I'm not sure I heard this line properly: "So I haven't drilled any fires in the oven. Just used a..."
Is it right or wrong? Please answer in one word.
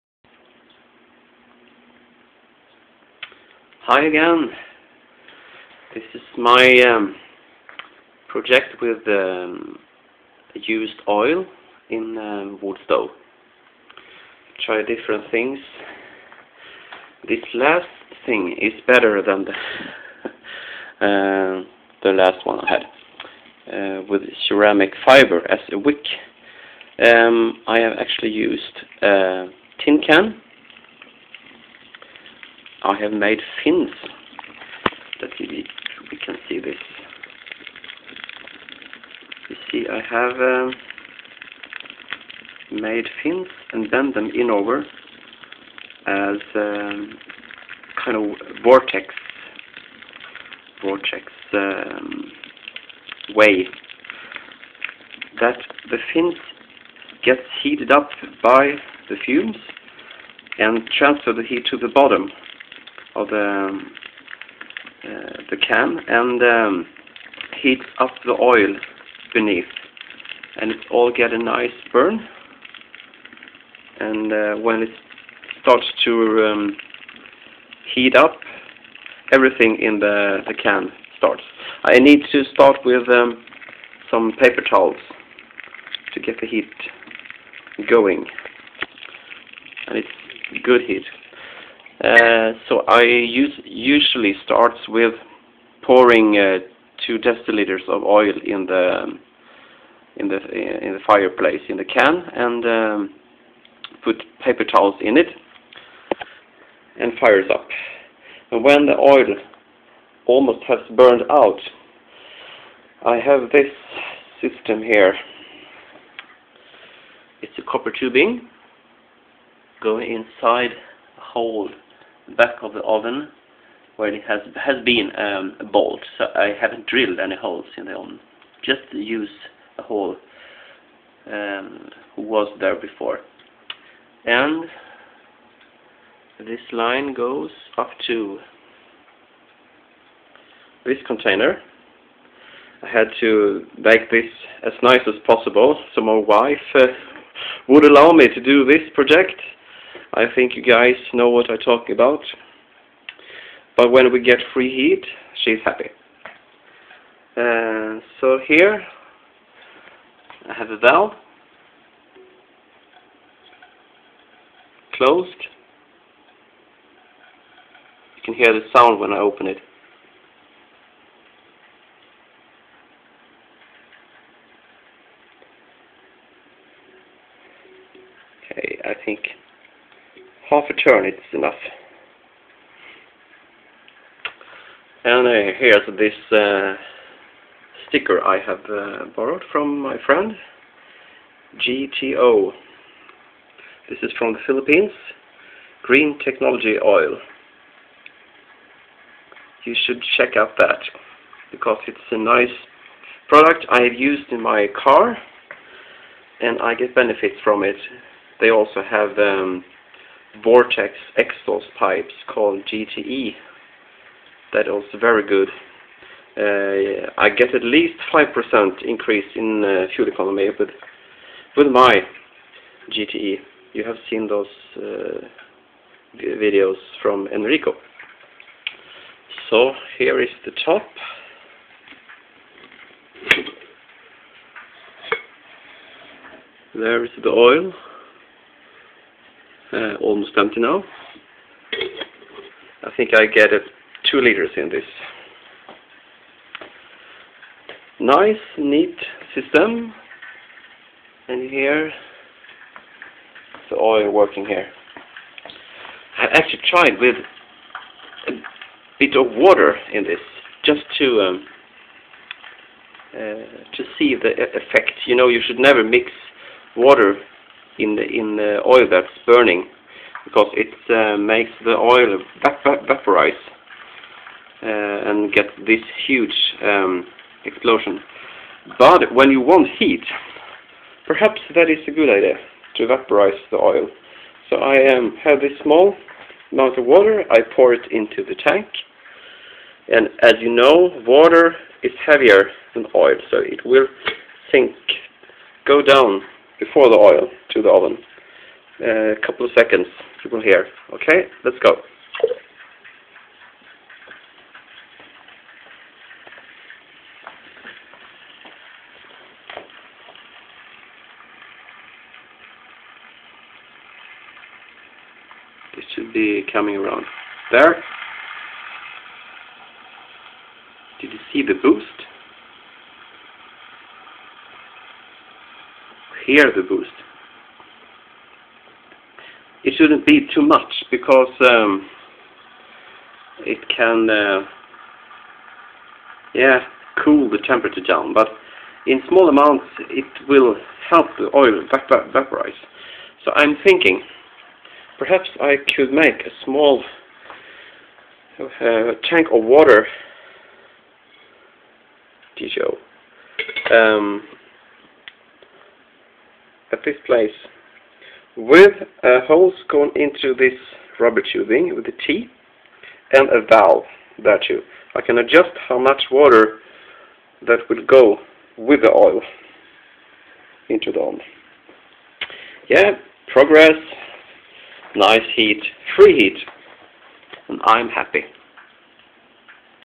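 wrong.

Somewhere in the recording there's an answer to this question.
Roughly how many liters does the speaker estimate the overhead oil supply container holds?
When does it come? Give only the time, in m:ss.
4:04.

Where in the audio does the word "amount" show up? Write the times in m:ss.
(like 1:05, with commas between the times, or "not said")
4:46, 5:39.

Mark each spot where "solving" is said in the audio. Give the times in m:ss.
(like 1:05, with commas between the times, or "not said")
not said.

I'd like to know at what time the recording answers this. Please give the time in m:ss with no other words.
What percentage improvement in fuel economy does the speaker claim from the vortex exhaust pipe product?
3:38.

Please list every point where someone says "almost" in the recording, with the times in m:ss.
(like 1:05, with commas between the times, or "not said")
1:50, 4:00.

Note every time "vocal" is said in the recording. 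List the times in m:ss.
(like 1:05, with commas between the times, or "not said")
not said.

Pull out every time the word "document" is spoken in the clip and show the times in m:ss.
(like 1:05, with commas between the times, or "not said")
not said.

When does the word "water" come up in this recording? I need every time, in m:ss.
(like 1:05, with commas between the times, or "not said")
4:19, 4:26, 4:46, 4:51, 5:49, 6:06.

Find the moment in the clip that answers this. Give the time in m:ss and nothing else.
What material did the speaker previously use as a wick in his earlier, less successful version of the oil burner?
0:24.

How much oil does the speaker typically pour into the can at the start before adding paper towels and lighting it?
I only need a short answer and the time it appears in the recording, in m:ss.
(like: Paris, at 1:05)
2 deciliters, at 1:37.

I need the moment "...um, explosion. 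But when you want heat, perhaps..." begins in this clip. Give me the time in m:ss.
4:36.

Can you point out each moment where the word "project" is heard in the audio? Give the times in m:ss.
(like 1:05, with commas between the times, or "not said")
0:08, 2:28.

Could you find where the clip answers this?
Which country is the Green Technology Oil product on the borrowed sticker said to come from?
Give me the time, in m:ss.
3:14.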